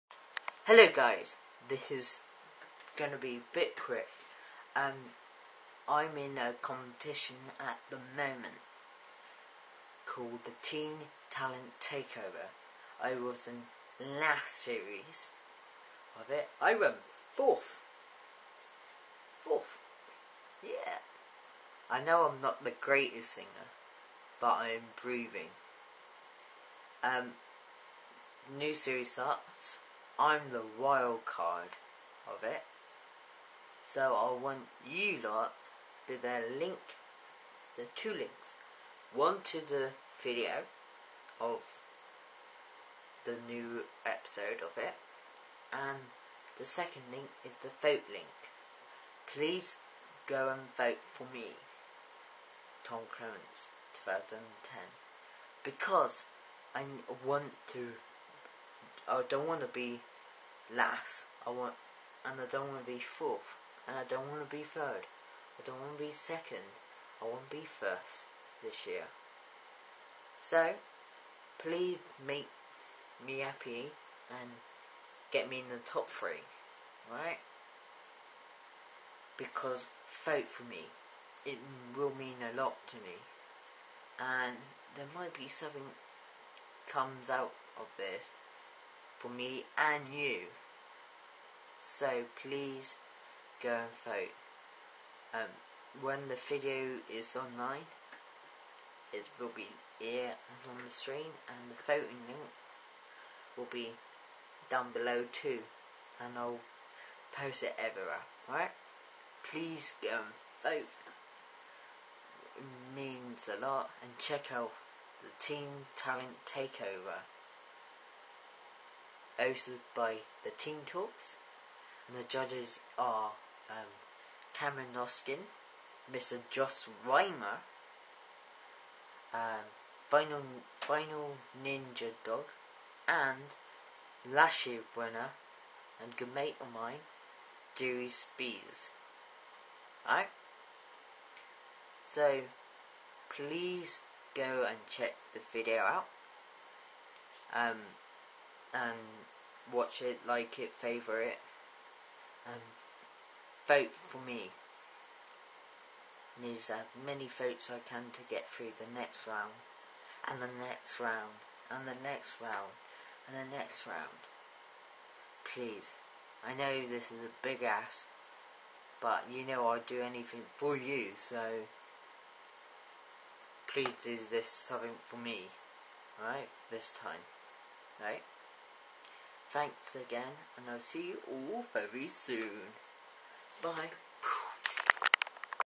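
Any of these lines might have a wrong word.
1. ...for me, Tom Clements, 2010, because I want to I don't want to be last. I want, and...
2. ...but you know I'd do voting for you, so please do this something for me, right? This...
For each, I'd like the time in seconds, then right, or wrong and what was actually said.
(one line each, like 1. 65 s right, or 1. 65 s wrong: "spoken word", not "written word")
1. 51 s right
2. 169 s wrong: "anything", not "voting".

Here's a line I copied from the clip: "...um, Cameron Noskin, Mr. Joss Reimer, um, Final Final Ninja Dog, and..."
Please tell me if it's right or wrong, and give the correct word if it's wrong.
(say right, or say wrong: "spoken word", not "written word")
right.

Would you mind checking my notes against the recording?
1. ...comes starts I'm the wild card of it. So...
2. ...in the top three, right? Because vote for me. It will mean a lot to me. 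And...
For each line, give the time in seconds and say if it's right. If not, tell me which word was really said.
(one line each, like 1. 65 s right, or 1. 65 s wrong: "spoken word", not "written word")
1. 28 s wrong: "series", not "comes"
2. 75 s right.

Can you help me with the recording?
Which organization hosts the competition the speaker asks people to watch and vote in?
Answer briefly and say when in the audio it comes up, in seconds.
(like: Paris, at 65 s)
The Teen Talks, at 120 s.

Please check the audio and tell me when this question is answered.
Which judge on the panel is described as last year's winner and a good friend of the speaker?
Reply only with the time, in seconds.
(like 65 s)
137 s.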